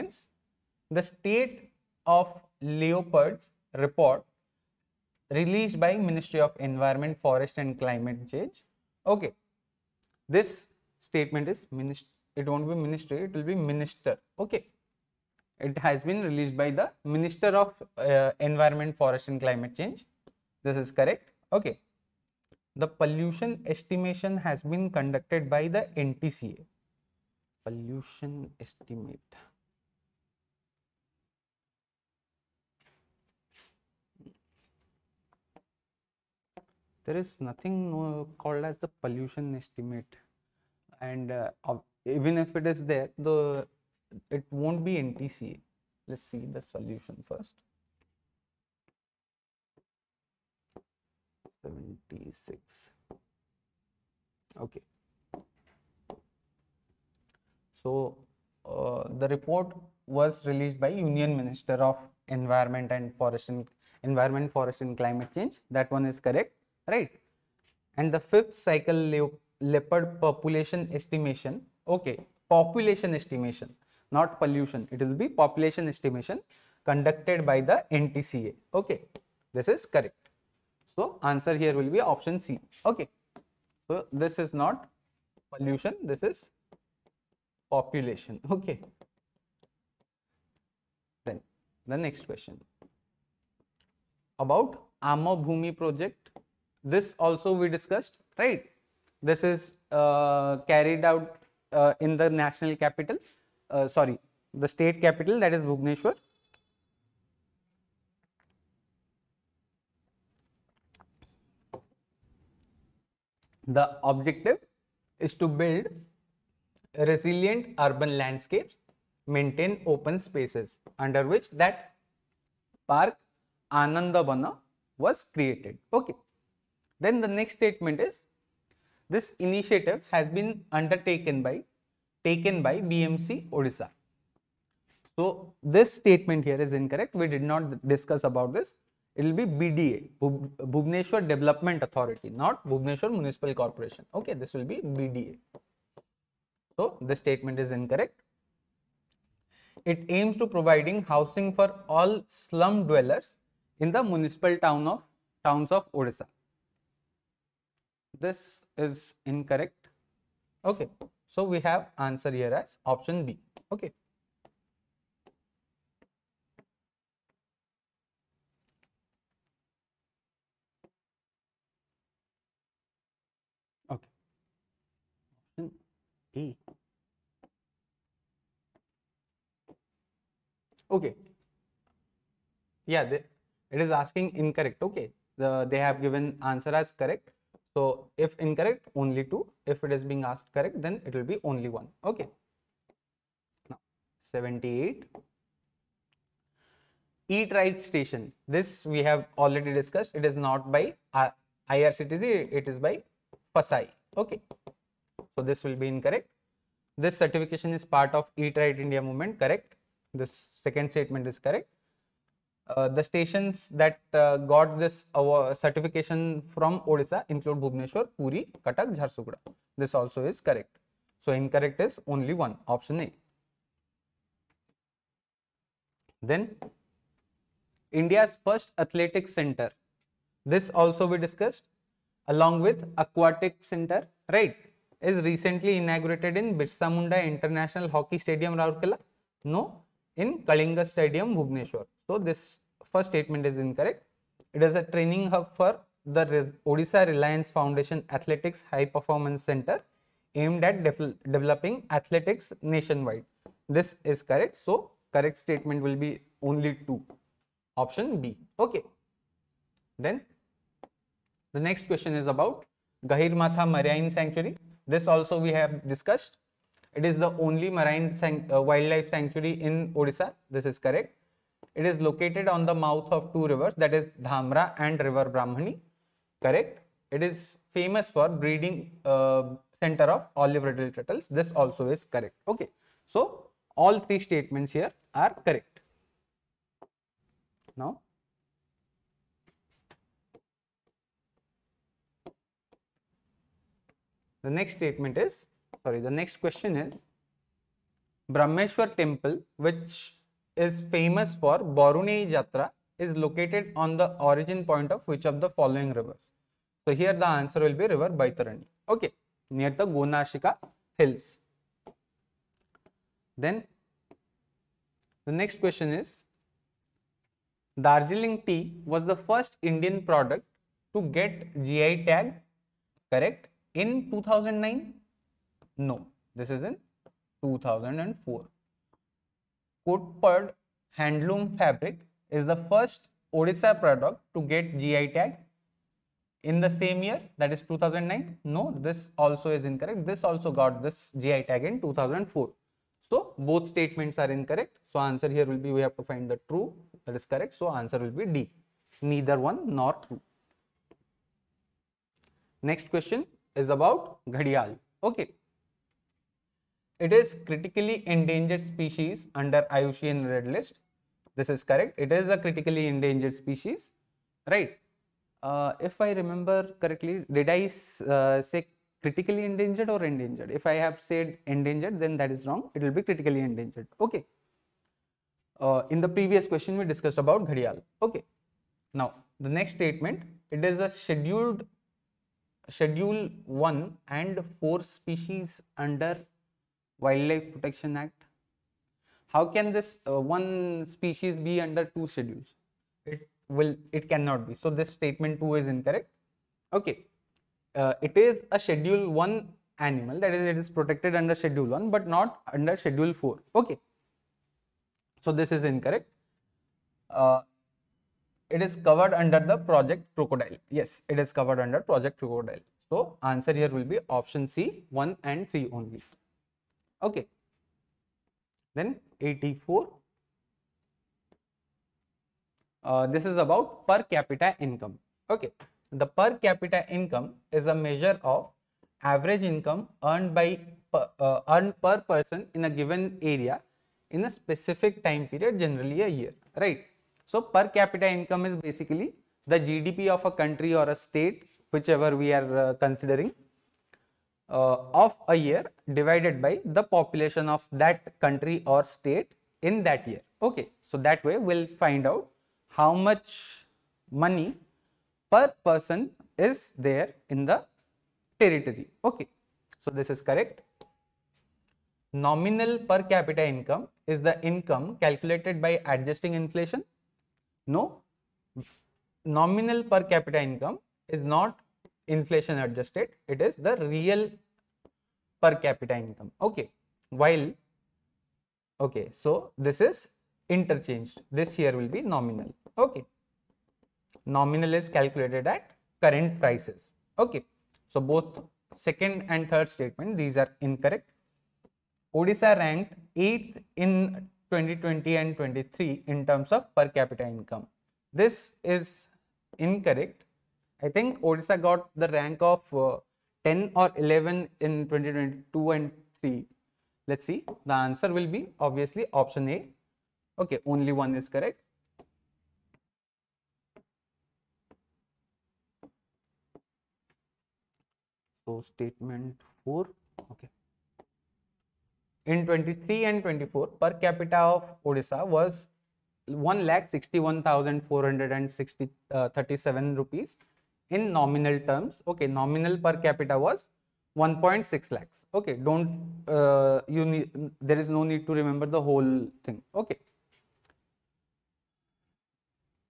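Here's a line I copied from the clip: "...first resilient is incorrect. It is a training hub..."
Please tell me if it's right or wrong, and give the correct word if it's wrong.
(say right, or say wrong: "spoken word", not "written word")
wrong: "statement", not "resilient".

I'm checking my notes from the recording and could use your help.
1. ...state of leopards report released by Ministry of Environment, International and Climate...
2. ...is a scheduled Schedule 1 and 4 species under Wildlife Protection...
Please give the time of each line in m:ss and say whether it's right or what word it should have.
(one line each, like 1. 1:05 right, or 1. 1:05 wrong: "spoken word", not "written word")
1. 0:01 wrong: "Forest", not "International"
2. 6:20 right.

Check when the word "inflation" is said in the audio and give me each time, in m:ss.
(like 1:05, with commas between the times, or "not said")
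7:46, 7:52.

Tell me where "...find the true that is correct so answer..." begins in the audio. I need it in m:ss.
5:46.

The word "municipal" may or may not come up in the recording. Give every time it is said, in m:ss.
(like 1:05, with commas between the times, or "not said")
2:23, 2:34.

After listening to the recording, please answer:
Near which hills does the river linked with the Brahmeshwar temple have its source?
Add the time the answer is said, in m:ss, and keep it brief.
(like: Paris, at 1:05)
Gonashika hills, at 5:09.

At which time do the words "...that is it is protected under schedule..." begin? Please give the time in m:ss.
6:40.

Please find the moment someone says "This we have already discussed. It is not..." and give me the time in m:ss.
3:18.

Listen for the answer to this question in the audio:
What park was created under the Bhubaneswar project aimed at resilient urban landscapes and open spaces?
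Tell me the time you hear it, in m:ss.
2:03.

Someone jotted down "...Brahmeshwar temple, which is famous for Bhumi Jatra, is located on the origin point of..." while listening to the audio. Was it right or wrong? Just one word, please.
wrong.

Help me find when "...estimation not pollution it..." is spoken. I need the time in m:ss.
1:13.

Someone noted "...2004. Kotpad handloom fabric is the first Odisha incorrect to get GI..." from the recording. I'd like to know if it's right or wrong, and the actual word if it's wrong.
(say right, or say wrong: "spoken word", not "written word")
wrong: "product", not "incorrect".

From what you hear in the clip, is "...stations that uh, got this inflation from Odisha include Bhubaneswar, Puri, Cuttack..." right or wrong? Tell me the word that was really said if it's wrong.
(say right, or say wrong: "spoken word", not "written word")
wrong: "certification", not "inflation".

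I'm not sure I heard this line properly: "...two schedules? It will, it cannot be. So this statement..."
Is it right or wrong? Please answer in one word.
right.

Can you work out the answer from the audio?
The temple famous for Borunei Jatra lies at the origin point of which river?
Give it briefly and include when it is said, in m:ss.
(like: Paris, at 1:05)
Baitarani, at 5:08.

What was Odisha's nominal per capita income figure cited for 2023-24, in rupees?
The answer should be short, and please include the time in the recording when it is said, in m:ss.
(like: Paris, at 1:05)
1 lakh 61,437, at 8:46.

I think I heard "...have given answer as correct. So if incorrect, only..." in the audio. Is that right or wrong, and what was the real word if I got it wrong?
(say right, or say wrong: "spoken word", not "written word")
right.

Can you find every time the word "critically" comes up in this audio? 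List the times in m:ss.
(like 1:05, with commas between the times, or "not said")
5:57, 6:02, 6:09, 6:13.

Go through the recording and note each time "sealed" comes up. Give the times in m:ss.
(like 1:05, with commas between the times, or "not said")
not said.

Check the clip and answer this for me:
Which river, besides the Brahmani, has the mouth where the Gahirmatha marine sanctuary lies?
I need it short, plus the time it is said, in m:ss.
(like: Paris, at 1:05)
Dhamra, at 4:34.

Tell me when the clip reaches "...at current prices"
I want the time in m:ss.
8:05.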